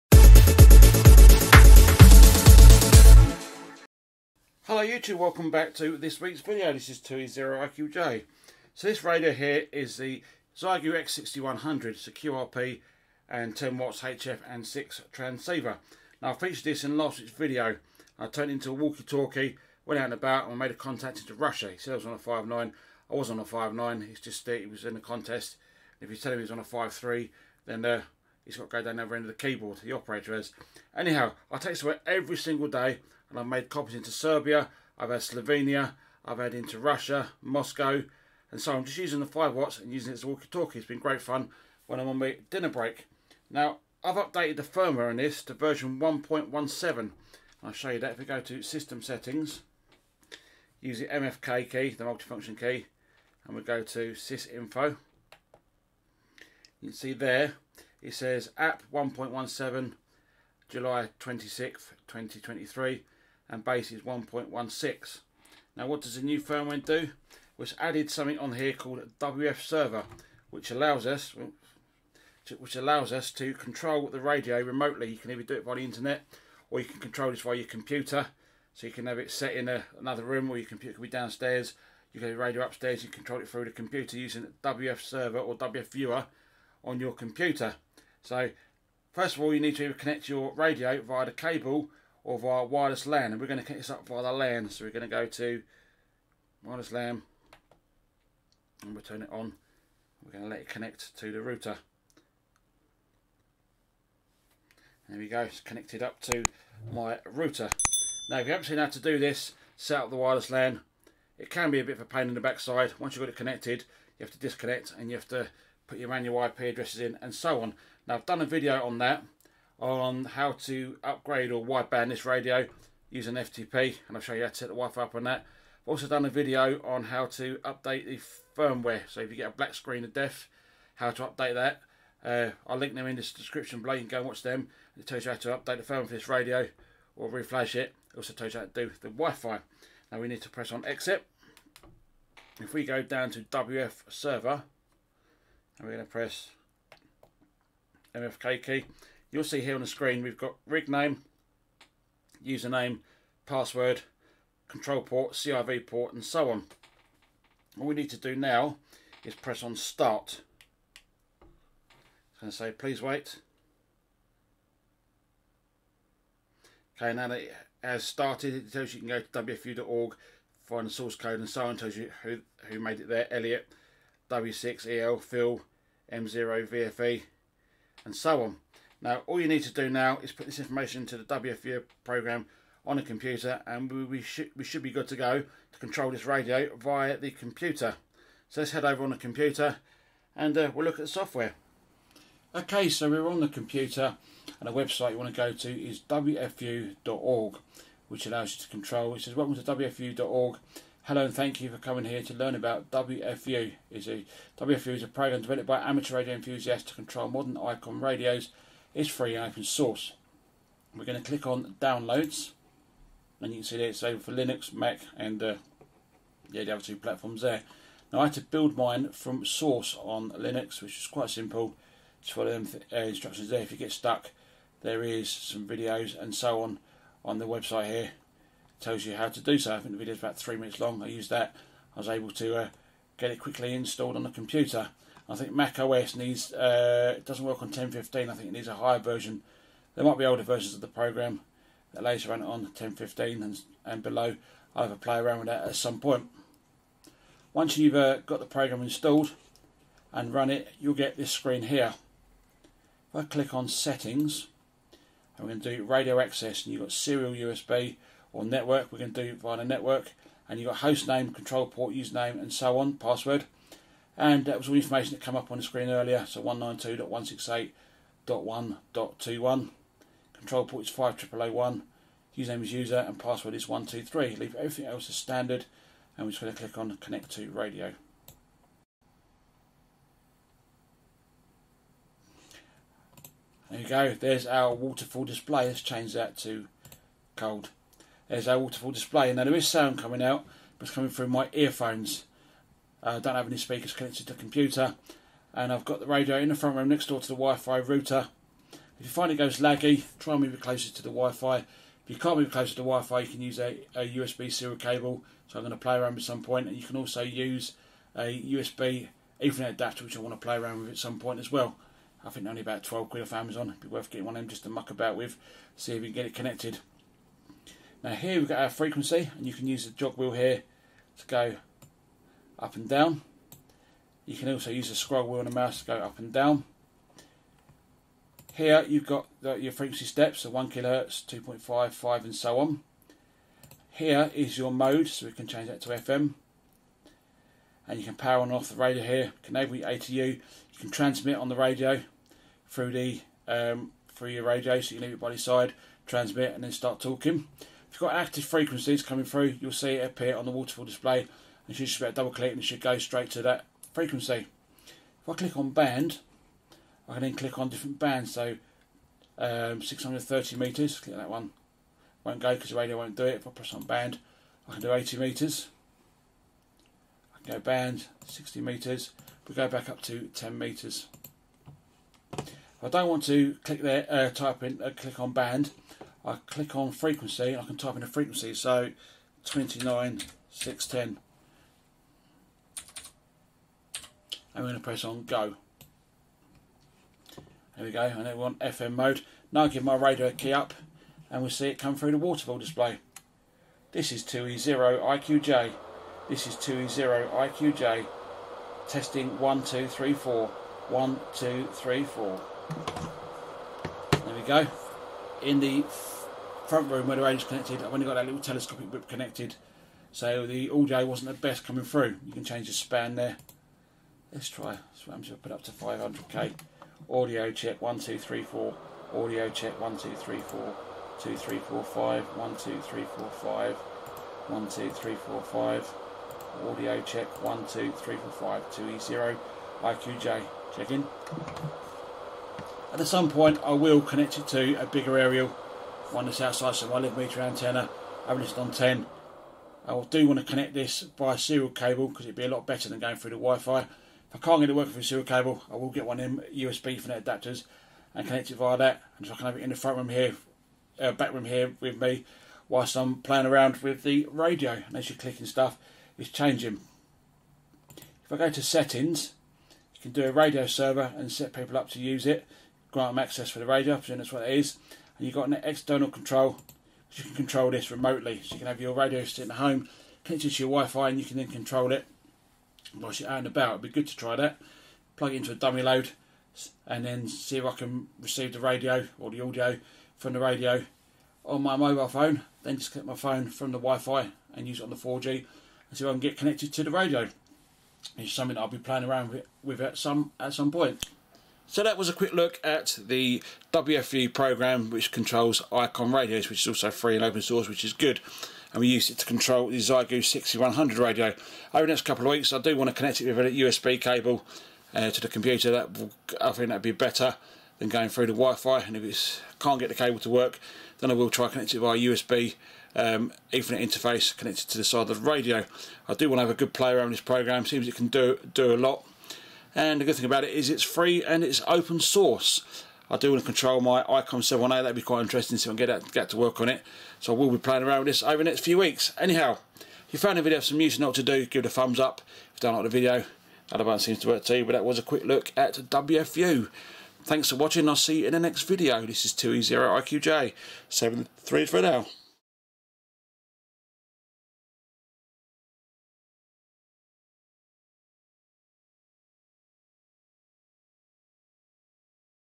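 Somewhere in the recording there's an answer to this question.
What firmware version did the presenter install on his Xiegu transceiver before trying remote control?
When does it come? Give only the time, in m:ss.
0:45.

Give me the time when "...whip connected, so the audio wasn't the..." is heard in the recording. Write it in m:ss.
6:48.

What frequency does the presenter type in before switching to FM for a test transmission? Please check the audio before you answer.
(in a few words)
29 610.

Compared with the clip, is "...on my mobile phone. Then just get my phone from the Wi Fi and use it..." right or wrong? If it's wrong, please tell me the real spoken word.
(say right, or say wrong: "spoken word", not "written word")
right.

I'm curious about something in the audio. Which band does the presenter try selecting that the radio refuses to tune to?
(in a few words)
630 meters.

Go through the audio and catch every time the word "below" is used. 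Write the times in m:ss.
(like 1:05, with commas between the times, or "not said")
2:13, 4:04.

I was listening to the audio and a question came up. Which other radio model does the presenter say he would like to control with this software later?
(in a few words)
Icom 7A.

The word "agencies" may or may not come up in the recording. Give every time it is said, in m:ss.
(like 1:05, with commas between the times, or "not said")
not said.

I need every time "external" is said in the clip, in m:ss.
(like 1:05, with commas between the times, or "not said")
7:45.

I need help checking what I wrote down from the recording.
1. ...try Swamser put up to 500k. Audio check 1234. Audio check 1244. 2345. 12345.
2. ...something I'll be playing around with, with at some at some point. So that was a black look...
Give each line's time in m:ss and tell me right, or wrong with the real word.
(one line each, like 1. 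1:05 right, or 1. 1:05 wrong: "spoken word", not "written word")
1. 6:54 wrong: "1234", not "1244"
2. 8:08 wrong: "quick", not "black".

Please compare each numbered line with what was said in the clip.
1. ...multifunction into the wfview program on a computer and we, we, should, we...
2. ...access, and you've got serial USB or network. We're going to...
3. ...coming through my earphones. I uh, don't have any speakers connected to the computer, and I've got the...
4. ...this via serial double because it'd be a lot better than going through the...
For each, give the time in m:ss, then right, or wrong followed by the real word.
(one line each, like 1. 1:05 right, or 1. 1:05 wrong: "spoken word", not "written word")
1. 3:00 wrong: "information", not "multifunction"
2. 4:16 right
3. 4:50 right
4. 7:20 wrong: "cable", not "double".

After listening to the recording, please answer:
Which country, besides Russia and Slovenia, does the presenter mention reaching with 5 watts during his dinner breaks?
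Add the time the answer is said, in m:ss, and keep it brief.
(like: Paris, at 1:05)
Serbia, at 0:34.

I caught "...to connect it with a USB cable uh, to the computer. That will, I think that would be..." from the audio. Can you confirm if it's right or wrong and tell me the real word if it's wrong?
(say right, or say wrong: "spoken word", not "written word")
right.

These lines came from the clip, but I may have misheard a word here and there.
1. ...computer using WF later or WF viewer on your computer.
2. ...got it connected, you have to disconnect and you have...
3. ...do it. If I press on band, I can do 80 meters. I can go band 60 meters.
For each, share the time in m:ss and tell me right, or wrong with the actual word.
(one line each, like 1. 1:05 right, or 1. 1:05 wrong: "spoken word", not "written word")
1. 1:23 wrong: "server", not "later"
2. 1:53 right
3. 6:03 right.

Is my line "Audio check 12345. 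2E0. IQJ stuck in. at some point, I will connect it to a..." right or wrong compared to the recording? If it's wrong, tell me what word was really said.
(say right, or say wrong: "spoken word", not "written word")
wrong: "check", not "stuck".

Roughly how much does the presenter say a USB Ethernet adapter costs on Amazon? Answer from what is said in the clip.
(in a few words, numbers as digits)
12 quid.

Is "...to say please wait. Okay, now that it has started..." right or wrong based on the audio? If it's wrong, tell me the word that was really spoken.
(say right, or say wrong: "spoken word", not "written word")
right.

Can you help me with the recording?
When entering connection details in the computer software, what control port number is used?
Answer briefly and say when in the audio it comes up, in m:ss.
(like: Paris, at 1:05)
5001, at 4:30.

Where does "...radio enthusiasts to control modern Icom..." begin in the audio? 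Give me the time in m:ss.
3:26.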